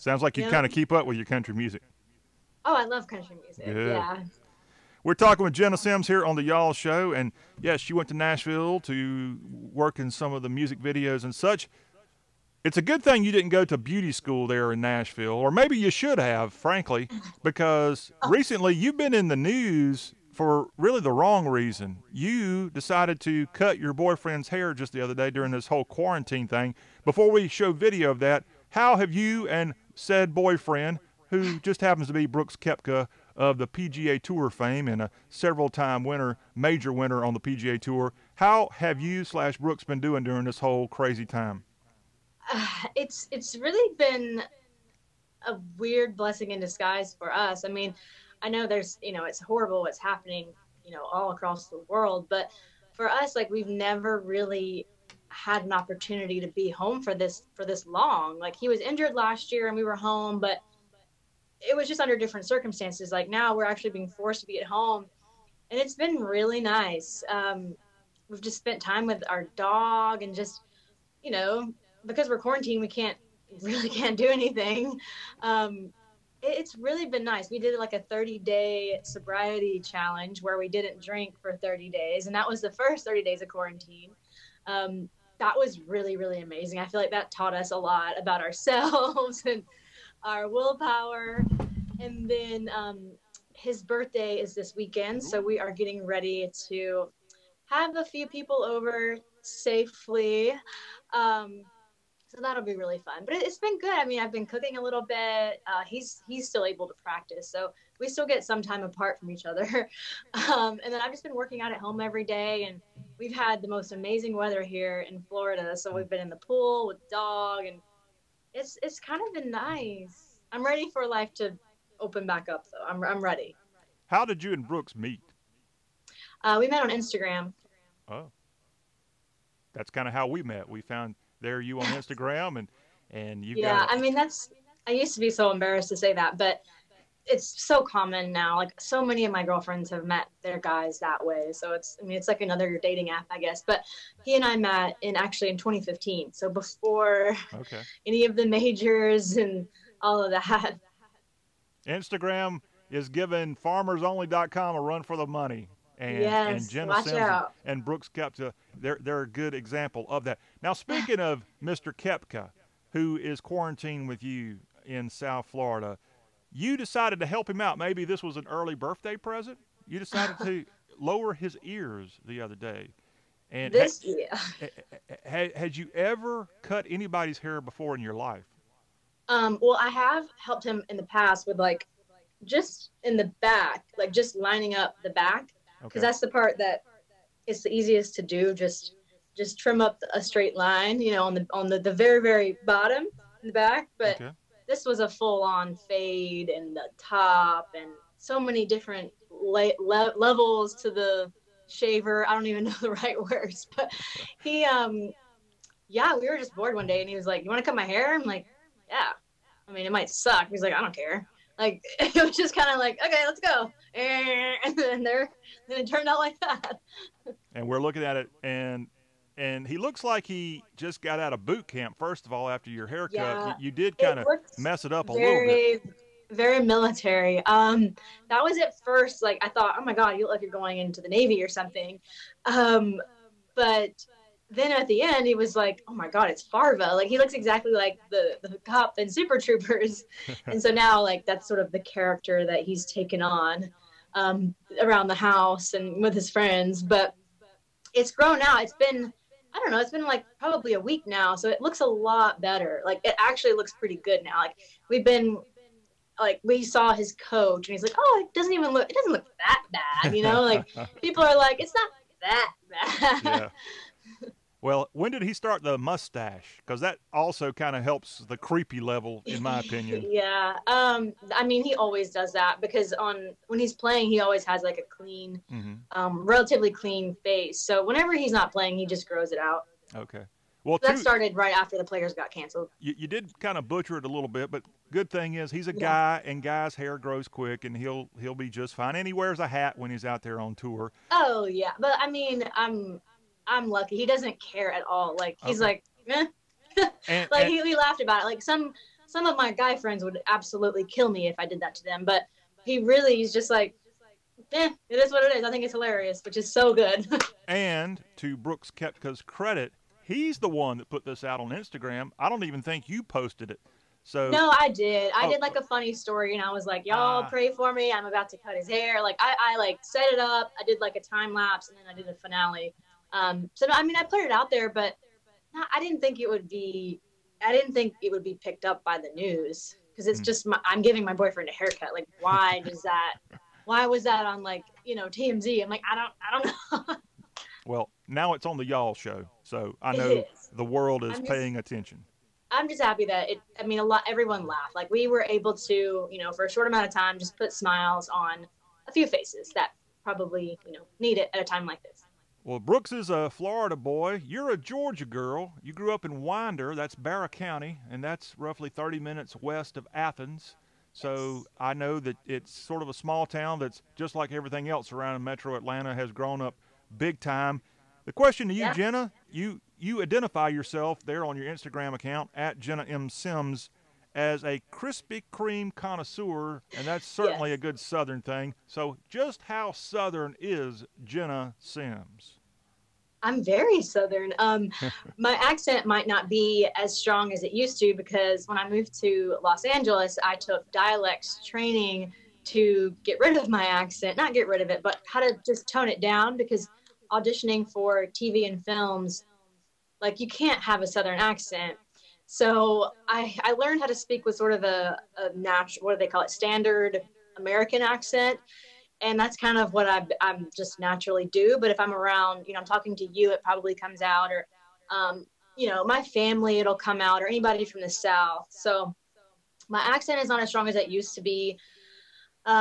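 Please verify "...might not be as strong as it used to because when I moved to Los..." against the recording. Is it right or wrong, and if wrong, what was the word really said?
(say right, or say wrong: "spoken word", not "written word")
right.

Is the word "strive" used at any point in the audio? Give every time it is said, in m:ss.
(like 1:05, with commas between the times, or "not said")
not said.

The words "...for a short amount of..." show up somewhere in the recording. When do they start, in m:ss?
5:46.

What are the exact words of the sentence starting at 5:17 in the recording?
I'm about to cut his hair." Like I, I like set it up.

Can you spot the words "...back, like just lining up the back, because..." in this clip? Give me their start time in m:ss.
3:03.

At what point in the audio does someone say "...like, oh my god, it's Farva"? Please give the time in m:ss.
3:55.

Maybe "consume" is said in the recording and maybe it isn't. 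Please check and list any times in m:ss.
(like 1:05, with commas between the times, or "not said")
not said.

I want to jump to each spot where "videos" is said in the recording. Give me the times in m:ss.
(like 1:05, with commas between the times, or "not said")
0:10, 0:27.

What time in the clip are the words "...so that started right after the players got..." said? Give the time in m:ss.
4:40.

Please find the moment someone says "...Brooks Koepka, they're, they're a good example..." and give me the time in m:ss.
2:37.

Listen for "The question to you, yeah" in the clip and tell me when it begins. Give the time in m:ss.
6:08.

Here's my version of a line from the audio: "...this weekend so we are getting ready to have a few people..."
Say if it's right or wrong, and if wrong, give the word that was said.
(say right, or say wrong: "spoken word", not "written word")
right.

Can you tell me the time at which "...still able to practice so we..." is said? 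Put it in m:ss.
1:46.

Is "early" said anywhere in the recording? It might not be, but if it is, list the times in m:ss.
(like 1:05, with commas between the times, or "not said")
2:48.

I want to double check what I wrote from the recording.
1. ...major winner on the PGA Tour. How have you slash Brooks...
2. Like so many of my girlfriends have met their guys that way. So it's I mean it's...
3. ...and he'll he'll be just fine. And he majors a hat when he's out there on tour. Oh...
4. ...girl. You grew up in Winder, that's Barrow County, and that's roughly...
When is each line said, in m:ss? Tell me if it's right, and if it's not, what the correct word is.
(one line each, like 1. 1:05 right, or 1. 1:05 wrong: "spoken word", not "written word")
1. 0:36 right
2. 2:18 right
3. 4:47 wrong: "wears", not "majors"
4. 5:55 right.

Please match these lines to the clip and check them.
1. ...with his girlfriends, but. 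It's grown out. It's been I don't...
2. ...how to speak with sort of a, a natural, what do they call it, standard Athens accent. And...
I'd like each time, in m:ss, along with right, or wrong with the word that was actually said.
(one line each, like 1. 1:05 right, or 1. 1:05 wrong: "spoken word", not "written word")
1. 4:06 wrong: "friends", not "girlfriends"
2. 6:43 wrong: "American", not "Athens".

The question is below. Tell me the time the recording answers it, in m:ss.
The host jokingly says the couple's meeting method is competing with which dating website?
2:33.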